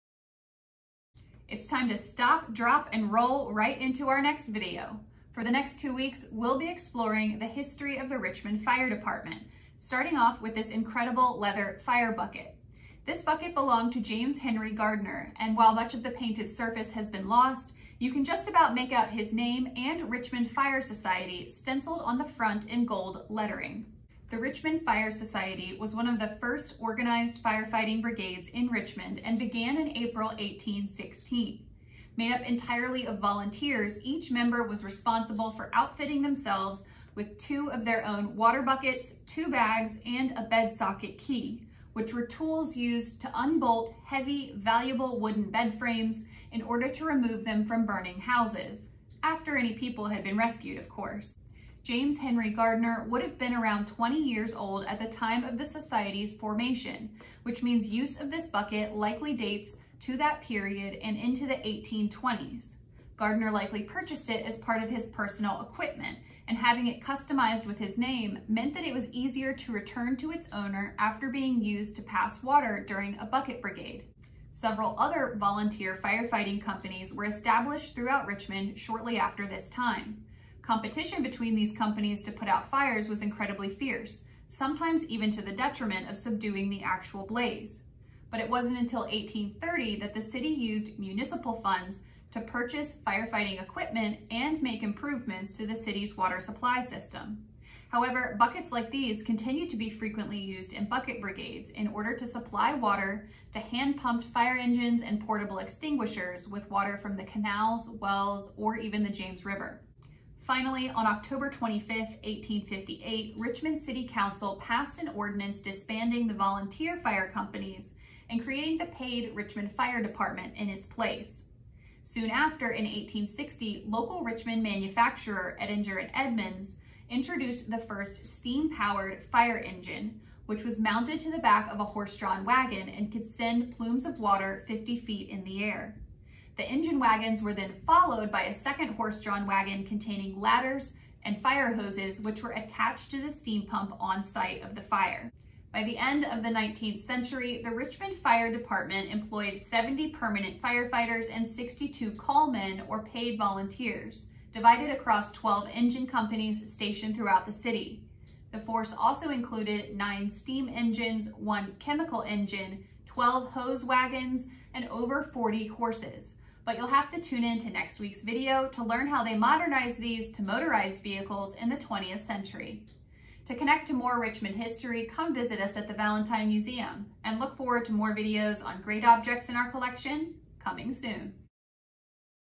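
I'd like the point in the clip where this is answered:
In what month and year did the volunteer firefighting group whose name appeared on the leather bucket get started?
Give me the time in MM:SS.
00:29.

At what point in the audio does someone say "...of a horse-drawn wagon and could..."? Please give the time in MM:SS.
02:11.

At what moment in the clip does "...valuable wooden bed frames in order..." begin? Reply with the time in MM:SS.
00:44.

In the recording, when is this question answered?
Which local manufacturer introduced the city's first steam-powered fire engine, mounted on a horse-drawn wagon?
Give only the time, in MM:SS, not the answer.
02:05.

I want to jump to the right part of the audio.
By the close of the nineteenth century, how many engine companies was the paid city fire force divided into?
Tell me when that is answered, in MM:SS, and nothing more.
02:35.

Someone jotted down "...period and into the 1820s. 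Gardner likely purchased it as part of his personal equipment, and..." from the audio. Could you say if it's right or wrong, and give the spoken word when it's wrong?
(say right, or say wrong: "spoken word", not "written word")
right.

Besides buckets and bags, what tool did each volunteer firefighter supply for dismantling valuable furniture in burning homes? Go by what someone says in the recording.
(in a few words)
bed socket key.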